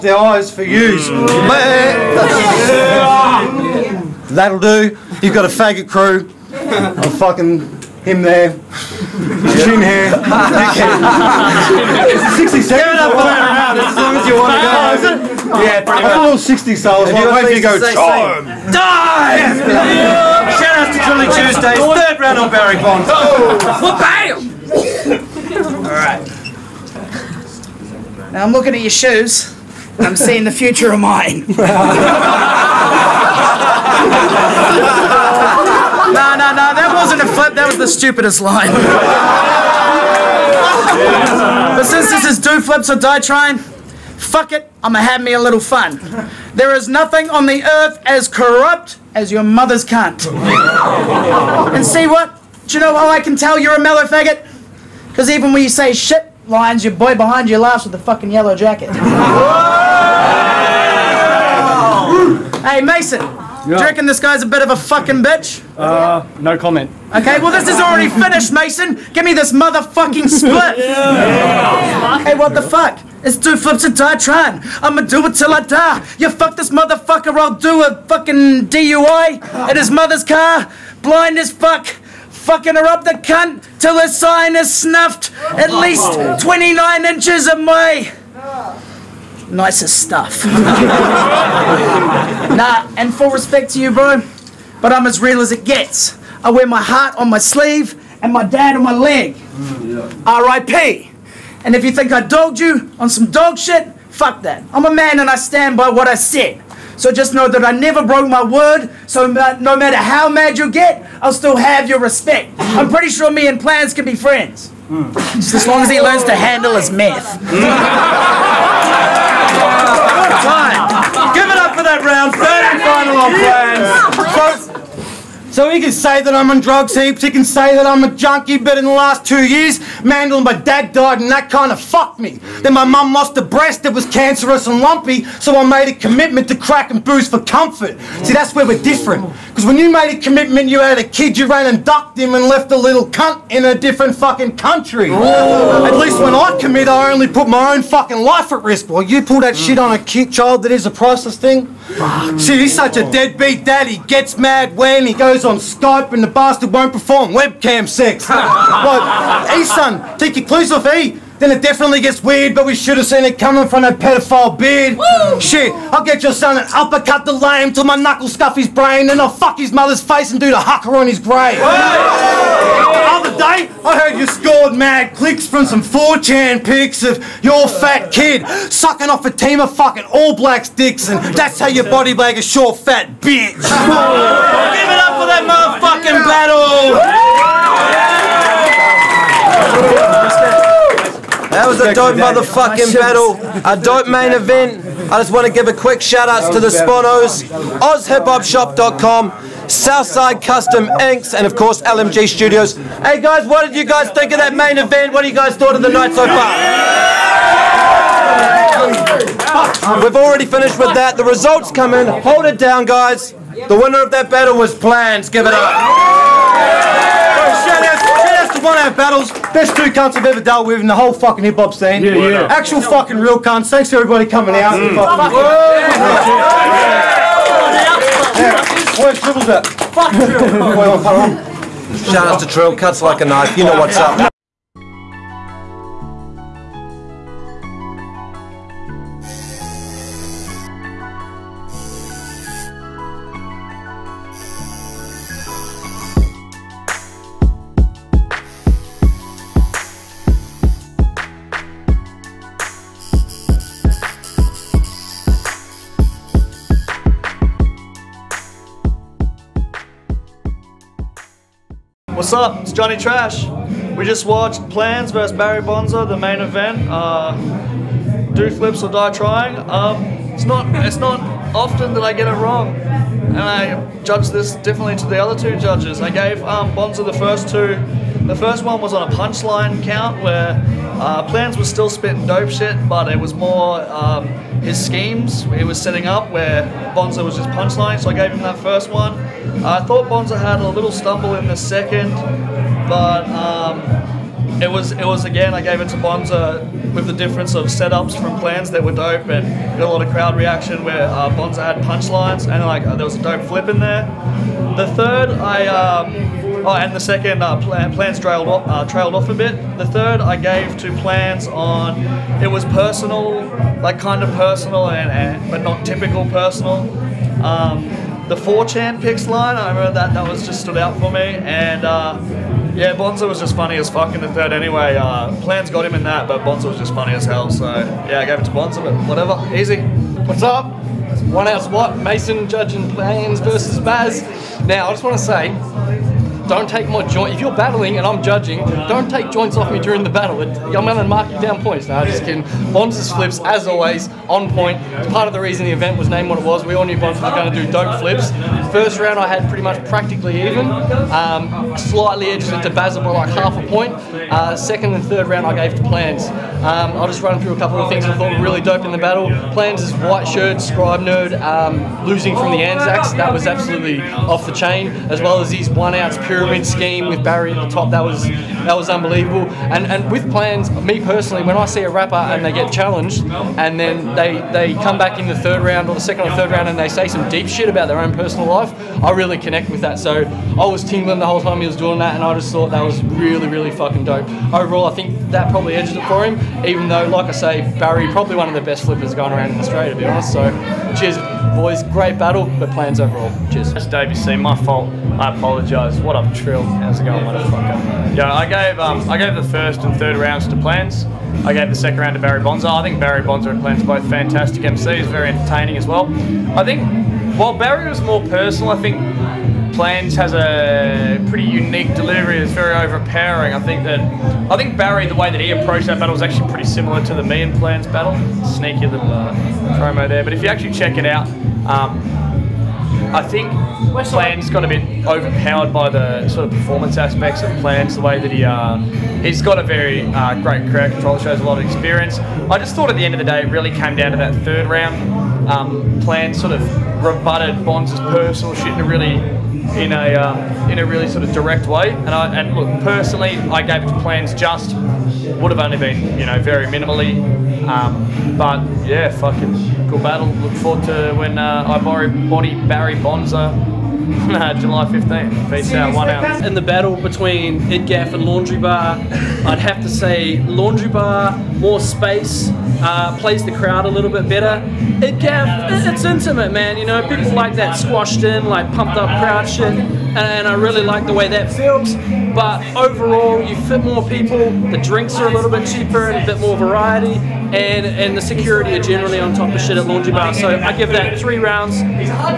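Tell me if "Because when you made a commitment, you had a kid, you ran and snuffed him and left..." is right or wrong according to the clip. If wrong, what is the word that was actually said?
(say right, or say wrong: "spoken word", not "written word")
wrong: "ducked", not "snuffed".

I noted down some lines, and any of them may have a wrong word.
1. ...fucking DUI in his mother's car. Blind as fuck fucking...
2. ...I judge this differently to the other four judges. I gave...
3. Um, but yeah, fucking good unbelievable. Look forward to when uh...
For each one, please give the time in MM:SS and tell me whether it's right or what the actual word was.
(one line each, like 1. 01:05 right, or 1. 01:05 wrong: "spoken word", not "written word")
1. 01:18 right
2. 04:33 wrong: "two", not "four"
3. 07:27 wrong: "battle", not "unbelievable".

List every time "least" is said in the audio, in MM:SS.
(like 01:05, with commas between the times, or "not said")
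01:25, 02:25.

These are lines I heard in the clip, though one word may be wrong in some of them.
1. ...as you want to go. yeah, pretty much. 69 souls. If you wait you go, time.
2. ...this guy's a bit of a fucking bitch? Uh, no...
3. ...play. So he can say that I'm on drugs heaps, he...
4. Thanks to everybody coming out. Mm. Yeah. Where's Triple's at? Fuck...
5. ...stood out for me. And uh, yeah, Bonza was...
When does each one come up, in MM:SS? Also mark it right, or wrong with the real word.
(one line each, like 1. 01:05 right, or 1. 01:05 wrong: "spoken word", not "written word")
1. 00:14 wrong: "60", not "69"
2. 01:04 right
3. 02:03 right
4. 03:43 right
5. 05:20 right.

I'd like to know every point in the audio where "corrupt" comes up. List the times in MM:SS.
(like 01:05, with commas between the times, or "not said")
00:48.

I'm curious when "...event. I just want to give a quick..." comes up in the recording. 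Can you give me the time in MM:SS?
03:14.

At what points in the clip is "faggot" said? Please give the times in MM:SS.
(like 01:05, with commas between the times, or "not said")
00:05, 00:54.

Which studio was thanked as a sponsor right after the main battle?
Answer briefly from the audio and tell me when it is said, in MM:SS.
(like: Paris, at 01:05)
LMG Studios, at 03:21.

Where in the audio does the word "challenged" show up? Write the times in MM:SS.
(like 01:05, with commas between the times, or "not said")
06:12.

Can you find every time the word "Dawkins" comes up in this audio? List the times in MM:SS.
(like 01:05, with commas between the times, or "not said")
not said.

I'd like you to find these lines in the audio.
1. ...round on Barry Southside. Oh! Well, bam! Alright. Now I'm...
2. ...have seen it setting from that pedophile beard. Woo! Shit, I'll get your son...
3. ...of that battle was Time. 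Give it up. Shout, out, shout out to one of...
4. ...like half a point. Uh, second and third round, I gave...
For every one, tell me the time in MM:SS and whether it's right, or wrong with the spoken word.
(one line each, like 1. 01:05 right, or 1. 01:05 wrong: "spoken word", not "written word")
1. 00:22 wrong: "Bond", not "Southside"
2. 02:42 wrong: "coming", not "setting"
3. 03:34 wrong: "Planz", not "Time"
4. 05:53 right.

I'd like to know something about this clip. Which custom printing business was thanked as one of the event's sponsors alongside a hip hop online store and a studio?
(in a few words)
Southside Custom Inks.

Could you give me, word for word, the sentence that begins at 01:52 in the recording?
I'm pretty sure me and Planz can be friends.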